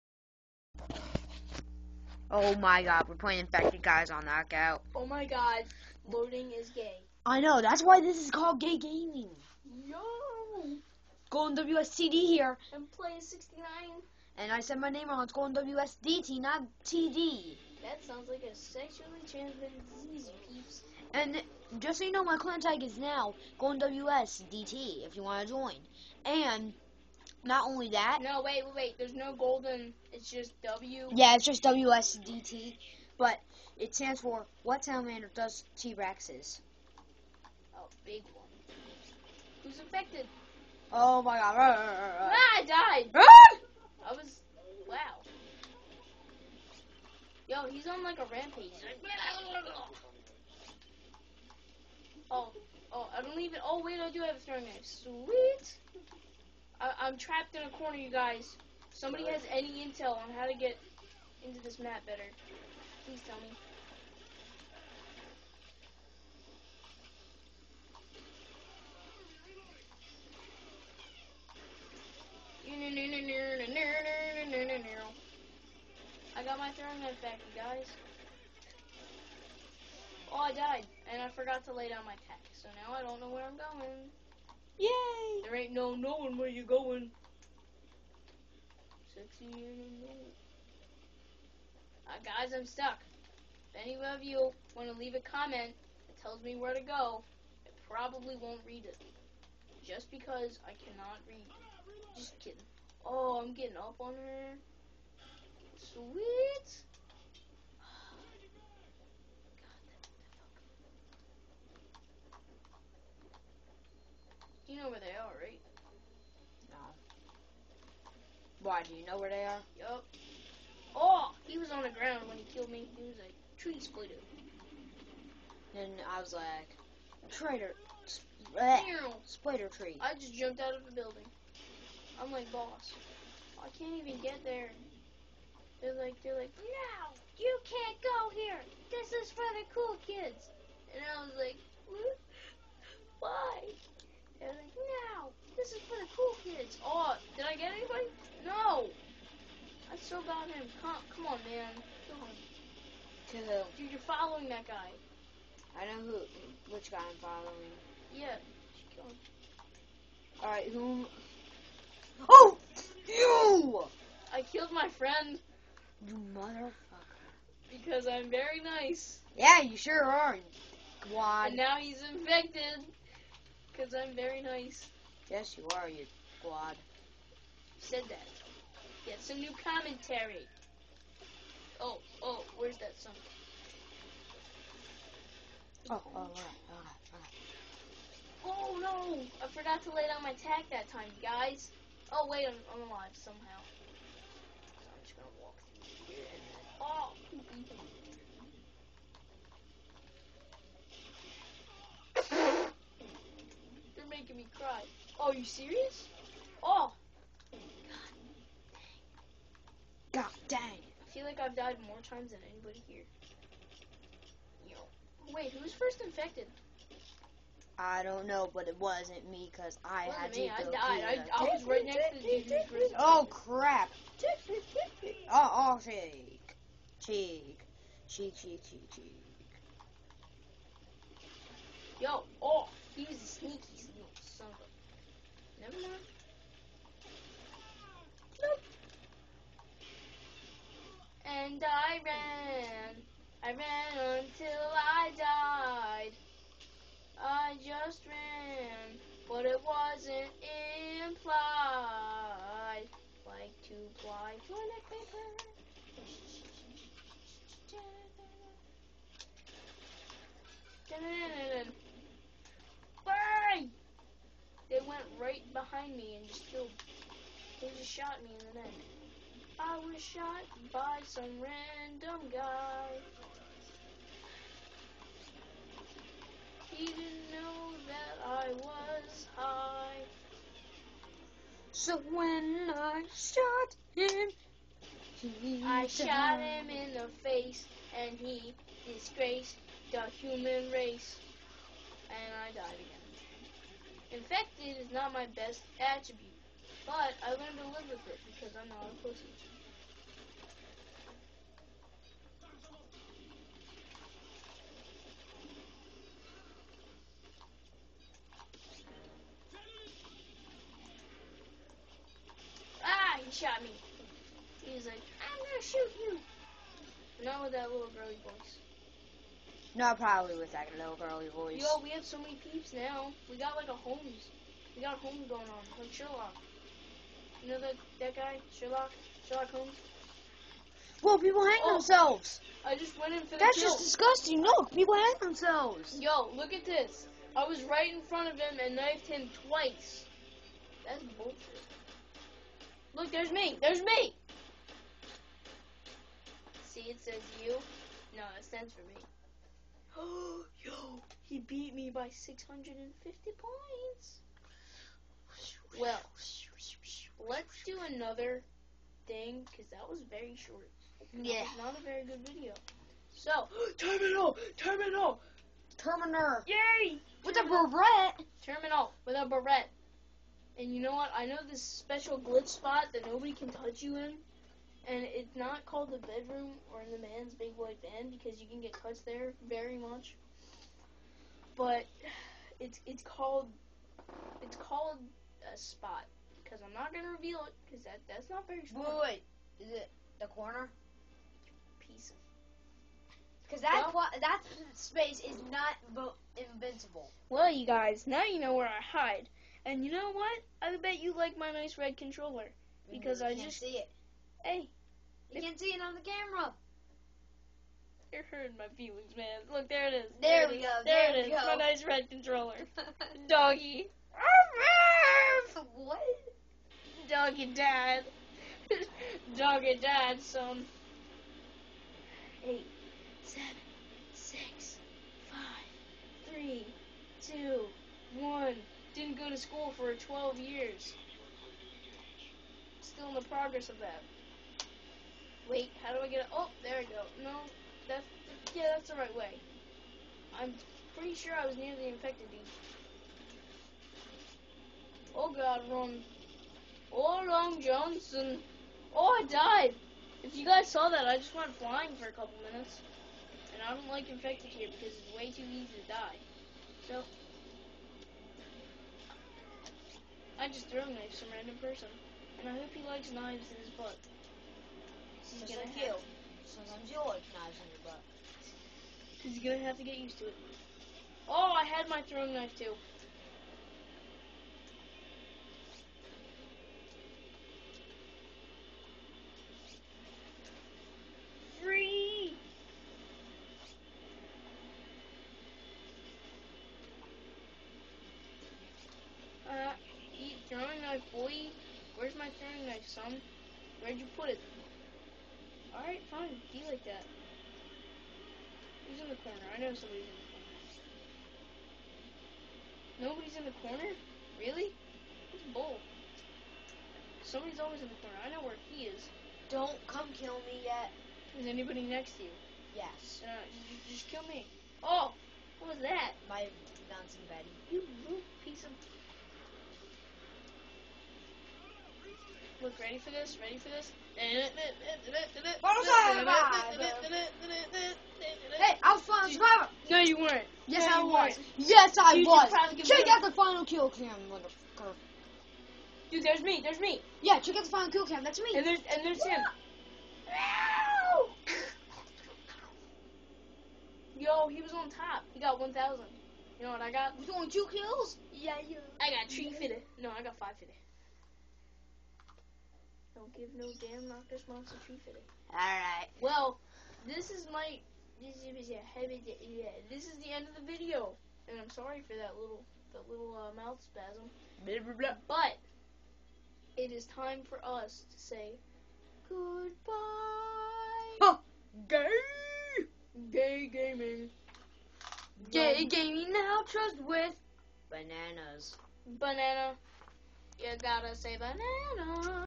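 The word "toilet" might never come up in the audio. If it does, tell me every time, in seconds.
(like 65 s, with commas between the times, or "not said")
254 s.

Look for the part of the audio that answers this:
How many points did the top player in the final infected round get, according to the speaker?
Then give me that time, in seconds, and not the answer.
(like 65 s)
545 s.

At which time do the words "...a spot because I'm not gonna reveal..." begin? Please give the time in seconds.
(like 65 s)
385 s.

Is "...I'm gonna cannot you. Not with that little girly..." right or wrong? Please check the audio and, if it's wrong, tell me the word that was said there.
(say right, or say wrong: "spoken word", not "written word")
wrong: "shoot", not "cannot".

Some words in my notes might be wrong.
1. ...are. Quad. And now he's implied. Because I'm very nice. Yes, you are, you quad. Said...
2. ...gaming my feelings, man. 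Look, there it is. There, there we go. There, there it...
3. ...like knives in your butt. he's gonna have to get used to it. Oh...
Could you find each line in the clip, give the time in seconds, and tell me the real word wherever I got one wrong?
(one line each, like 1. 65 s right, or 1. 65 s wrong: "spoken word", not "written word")
1. 170 s wrong: "infected", not "implied"
2. 408 s wrong: "hurting", not "gaming"
3. 466 s right.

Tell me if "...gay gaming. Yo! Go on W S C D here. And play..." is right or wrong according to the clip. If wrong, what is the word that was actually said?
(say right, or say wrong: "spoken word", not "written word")
right.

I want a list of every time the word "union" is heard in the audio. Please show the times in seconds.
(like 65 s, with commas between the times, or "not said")
not said.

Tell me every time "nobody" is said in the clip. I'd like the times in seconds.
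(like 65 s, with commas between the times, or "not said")
373 s, 503 s.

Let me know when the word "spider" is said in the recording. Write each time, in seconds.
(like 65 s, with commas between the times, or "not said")
128 s.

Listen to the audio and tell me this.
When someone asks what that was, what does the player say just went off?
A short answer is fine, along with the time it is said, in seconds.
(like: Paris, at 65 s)
bouncing Betty, at 516 s.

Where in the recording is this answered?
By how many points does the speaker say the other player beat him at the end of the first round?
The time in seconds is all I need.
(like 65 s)
352 s.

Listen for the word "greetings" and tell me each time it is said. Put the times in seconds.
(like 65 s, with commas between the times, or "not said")
not said.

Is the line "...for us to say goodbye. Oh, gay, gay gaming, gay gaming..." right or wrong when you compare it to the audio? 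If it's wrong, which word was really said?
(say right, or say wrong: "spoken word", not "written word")
right.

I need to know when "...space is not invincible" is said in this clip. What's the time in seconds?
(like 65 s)
394 s.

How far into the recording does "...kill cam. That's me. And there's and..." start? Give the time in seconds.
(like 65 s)
537 s.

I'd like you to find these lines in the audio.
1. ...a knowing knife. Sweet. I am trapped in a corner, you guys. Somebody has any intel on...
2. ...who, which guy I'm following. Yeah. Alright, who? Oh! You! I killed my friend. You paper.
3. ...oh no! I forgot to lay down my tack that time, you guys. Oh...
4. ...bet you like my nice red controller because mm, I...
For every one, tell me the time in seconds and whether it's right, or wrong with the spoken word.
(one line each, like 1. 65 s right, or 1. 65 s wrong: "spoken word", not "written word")
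1. 54 s wrong: "throwing", not "knowing"
2. 156 s wrong: "motherfucker", not "paper"
3. 188 s right
4. 400 s right.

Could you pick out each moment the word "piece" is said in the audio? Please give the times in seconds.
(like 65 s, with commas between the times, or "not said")
391 s, 518 s.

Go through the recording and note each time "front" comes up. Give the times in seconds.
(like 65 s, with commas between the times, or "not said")
338 s.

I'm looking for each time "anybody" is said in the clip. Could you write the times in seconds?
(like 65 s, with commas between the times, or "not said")
212 s, 511 s.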